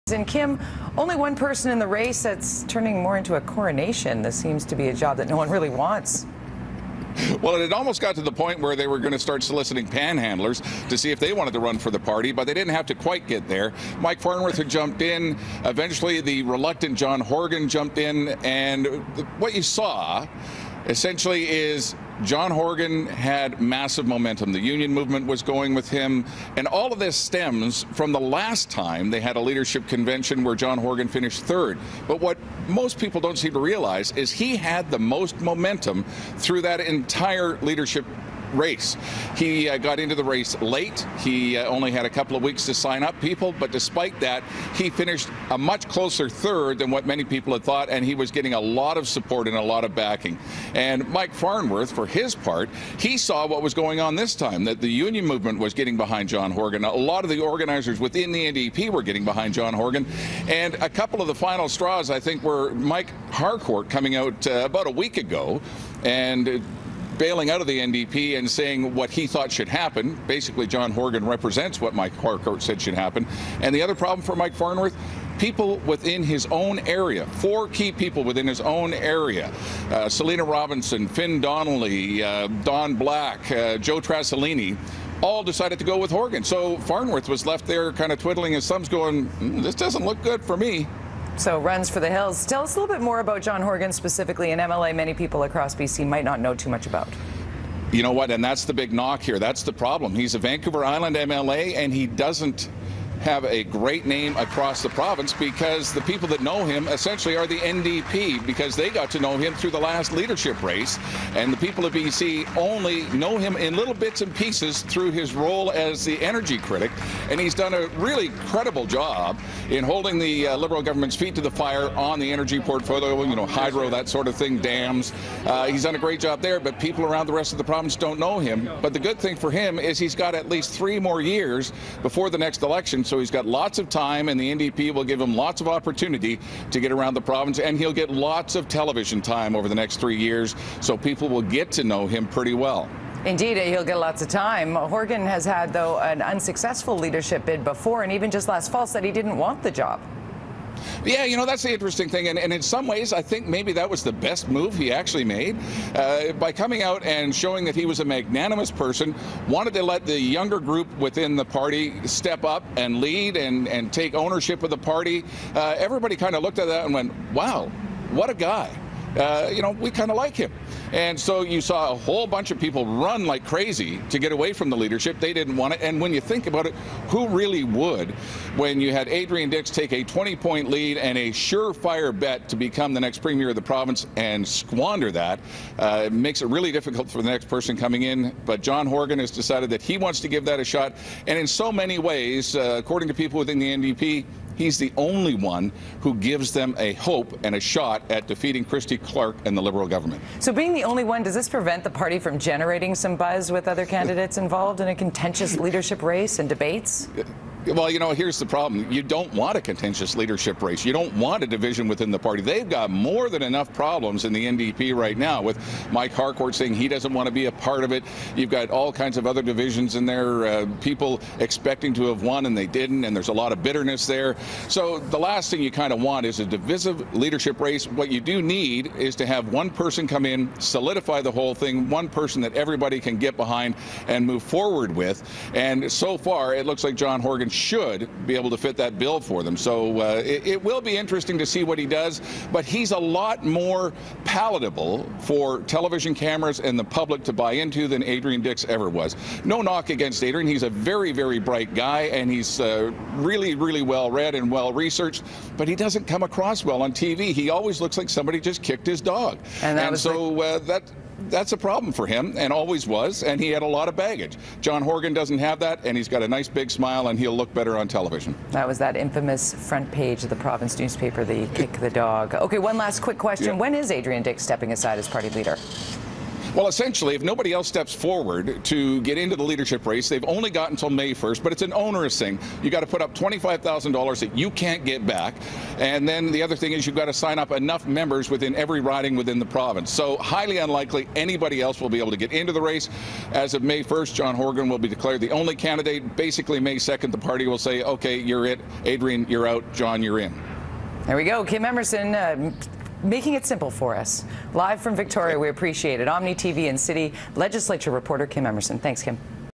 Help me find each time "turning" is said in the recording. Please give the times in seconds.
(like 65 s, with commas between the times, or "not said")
2 s.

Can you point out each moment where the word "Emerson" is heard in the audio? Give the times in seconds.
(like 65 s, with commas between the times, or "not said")
301 s, 308 s.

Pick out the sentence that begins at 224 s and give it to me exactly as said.
So the last thing you kind of want is a divisive leadership race.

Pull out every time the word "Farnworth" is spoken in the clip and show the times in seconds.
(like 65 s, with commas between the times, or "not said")
14 s, 51 s, 74 s, 86 s.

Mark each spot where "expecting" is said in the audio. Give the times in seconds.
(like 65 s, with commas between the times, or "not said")
221 s.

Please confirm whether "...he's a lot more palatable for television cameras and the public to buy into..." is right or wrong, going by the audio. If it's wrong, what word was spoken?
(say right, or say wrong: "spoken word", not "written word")
right.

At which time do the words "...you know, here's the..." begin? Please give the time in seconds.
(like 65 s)
207 s.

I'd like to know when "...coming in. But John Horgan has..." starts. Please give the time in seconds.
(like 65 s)
187 s.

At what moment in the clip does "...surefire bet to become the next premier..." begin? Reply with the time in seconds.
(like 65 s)
181 s.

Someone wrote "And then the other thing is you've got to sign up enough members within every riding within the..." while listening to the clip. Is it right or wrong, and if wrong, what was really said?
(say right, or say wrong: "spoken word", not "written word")
right.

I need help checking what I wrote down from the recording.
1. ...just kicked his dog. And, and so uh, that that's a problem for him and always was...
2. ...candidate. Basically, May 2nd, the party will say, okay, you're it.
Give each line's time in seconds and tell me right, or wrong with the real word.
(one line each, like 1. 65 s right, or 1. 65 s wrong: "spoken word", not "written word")
1. 258 s right
2. 295 s right.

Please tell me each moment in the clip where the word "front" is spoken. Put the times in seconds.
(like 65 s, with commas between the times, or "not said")
269 s.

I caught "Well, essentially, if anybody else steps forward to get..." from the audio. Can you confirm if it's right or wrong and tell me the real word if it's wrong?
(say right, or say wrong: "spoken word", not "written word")
wrong: "nobody", not "anybody".